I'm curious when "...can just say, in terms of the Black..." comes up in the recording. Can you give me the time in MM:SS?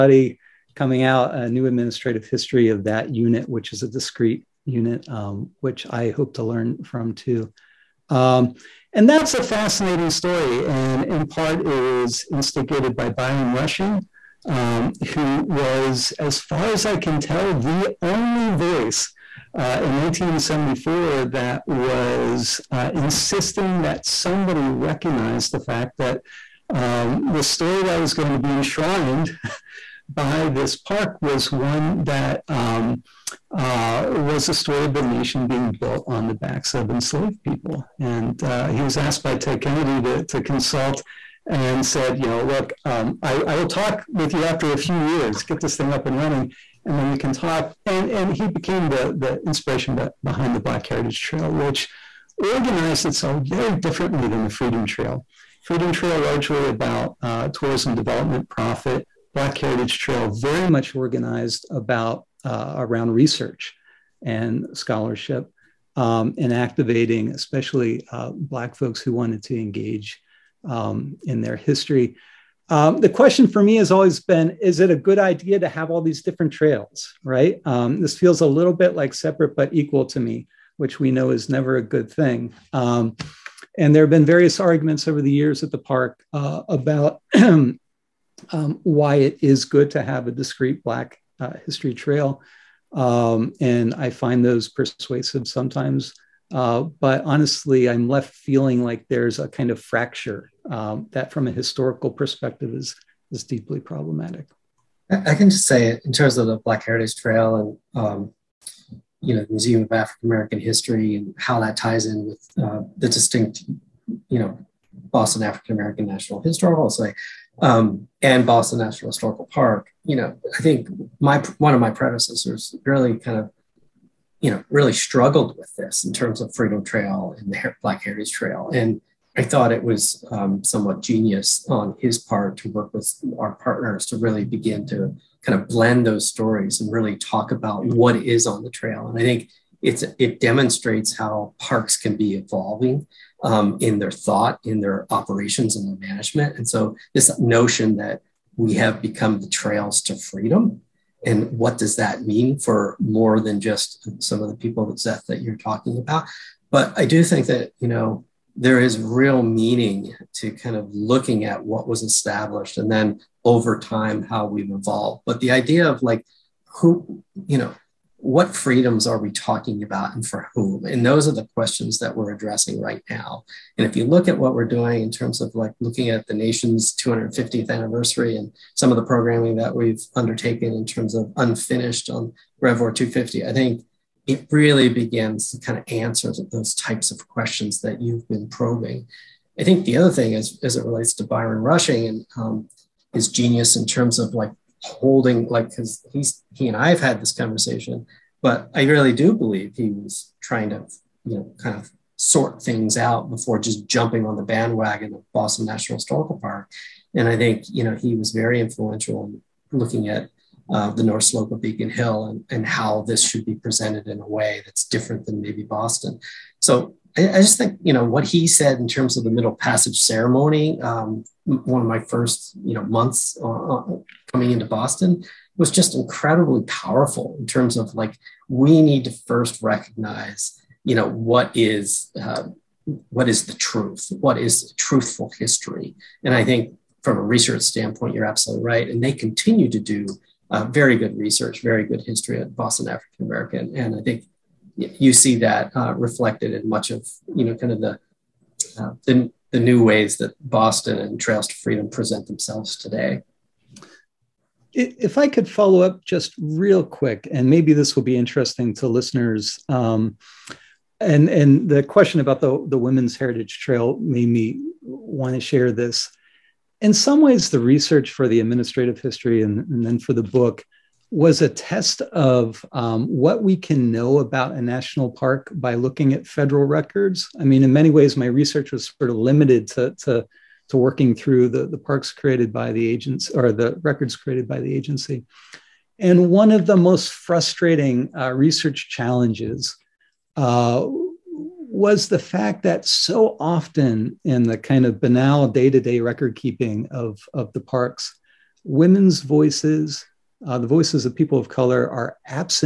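01:45.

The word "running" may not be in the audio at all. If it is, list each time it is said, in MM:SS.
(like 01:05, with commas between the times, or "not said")
00:46.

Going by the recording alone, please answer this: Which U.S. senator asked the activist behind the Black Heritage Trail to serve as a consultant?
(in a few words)
Ted Kennedy.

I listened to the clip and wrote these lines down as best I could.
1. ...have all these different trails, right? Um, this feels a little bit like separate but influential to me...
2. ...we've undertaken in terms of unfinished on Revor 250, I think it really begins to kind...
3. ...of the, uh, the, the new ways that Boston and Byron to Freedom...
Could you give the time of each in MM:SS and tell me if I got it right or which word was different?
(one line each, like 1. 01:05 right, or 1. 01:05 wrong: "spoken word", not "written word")
1. 01:15 wrong: "equal", not "influential"
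2. 02:59 right
3. 04:07 wrong: "Trails", not "Byron".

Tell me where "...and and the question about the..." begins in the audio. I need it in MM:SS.
04:20.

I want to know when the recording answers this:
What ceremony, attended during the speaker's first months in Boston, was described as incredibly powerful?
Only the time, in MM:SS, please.
03:39.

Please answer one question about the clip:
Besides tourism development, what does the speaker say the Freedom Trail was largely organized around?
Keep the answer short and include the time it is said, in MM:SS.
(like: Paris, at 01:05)
Profit, at 00:58.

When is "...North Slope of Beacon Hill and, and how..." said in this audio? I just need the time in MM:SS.
03:31.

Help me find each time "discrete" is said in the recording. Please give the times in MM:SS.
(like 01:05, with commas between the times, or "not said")
00:03, 01:30.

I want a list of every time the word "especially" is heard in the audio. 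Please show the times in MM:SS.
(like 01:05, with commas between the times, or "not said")
01:07.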